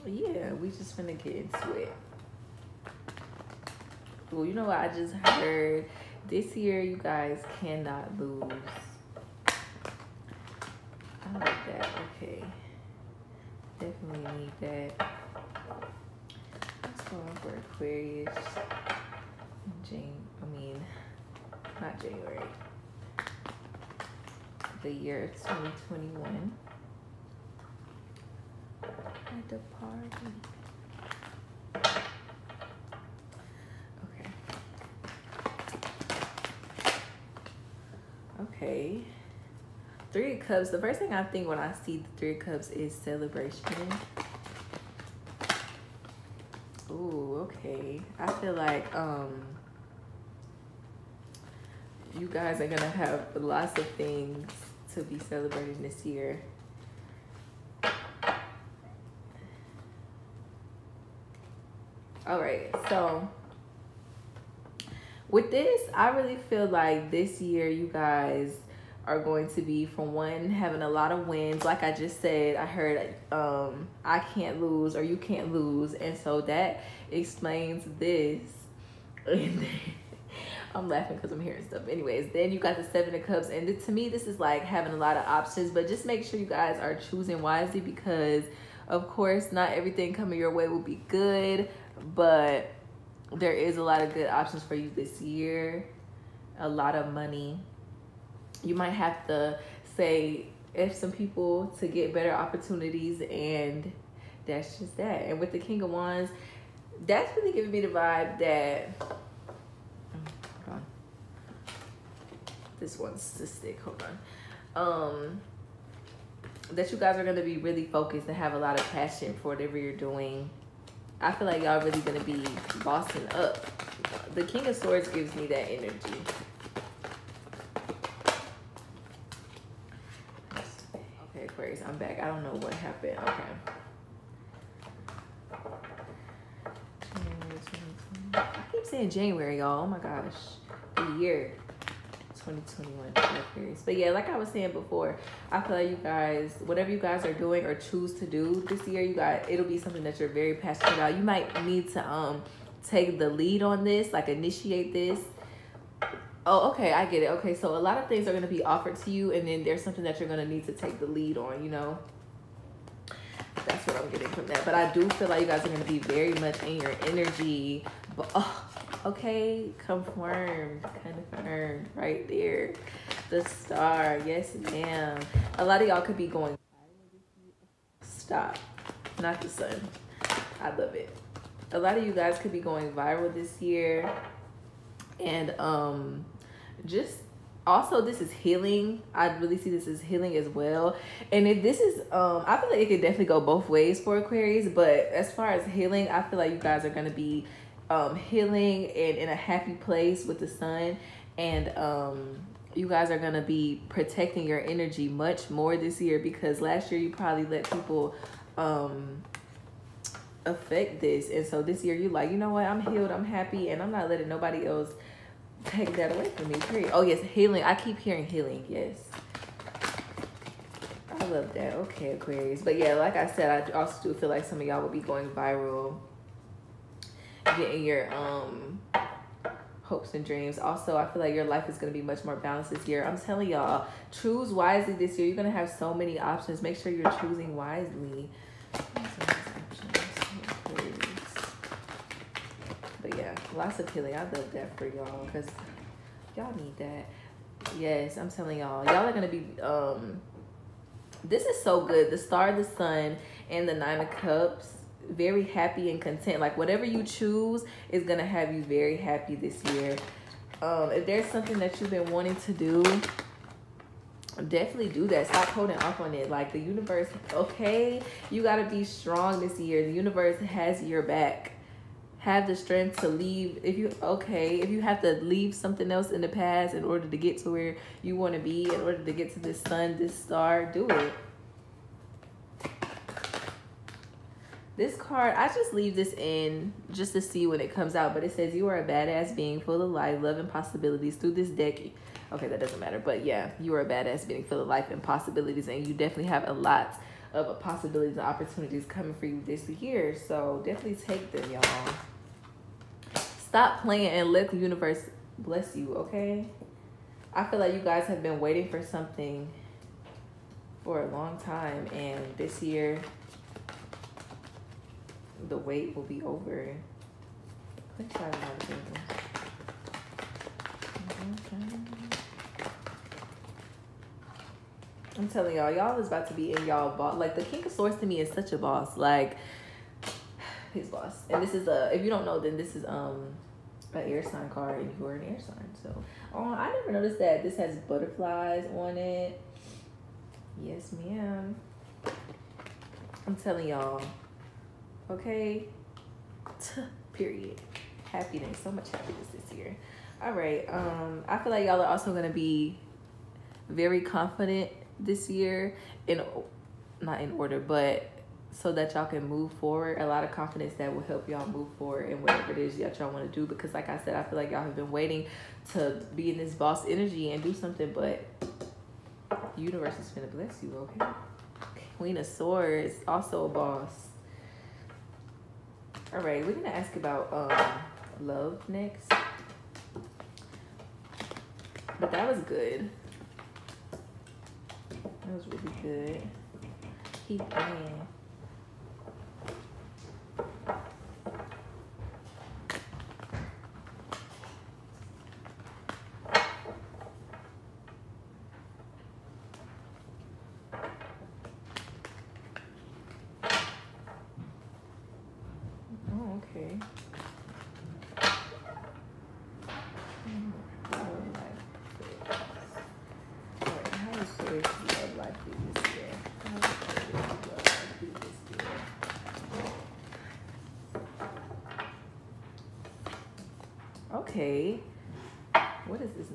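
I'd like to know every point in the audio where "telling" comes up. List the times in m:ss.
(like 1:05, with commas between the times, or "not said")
3:53, 4:08, 5:25, 5:43.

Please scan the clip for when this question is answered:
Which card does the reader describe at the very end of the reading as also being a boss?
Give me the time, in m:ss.
6:11.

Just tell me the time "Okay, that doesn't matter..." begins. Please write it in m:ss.
4:52.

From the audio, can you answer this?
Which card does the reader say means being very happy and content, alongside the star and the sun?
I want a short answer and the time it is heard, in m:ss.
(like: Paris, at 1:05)
Nine of Cups, at 4:13.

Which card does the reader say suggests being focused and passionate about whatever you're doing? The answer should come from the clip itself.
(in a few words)
King of Wands.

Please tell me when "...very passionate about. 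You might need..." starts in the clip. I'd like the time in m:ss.
2:30.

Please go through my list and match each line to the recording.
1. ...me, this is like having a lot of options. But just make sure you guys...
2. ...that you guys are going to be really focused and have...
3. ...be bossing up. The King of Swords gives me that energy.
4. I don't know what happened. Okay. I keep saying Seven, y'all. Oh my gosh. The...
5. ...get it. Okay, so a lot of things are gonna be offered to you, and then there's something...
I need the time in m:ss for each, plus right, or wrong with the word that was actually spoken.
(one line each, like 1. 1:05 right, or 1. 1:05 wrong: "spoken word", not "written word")
1. 1:23 right
2. 1:56 right
3. 2:02 right
4. 2:12 wrong: "January", not "Seven"
5. 2:37 right.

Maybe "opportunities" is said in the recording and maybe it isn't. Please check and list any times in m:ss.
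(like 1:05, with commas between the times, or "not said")
1:42, 4:58.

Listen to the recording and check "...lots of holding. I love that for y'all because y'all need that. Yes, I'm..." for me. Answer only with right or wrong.
wrong.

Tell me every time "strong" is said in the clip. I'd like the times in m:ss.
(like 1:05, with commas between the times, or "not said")
4:28.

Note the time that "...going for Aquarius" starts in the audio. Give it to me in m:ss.
0:17.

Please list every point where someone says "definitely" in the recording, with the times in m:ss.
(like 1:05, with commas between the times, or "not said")
0:13, 3:13, 4:24, 4:55, 5:00.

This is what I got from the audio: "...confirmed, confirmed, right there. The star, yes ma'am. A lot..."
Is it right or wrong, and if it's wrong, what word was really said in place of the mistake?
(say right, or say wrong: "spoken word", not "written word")
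right.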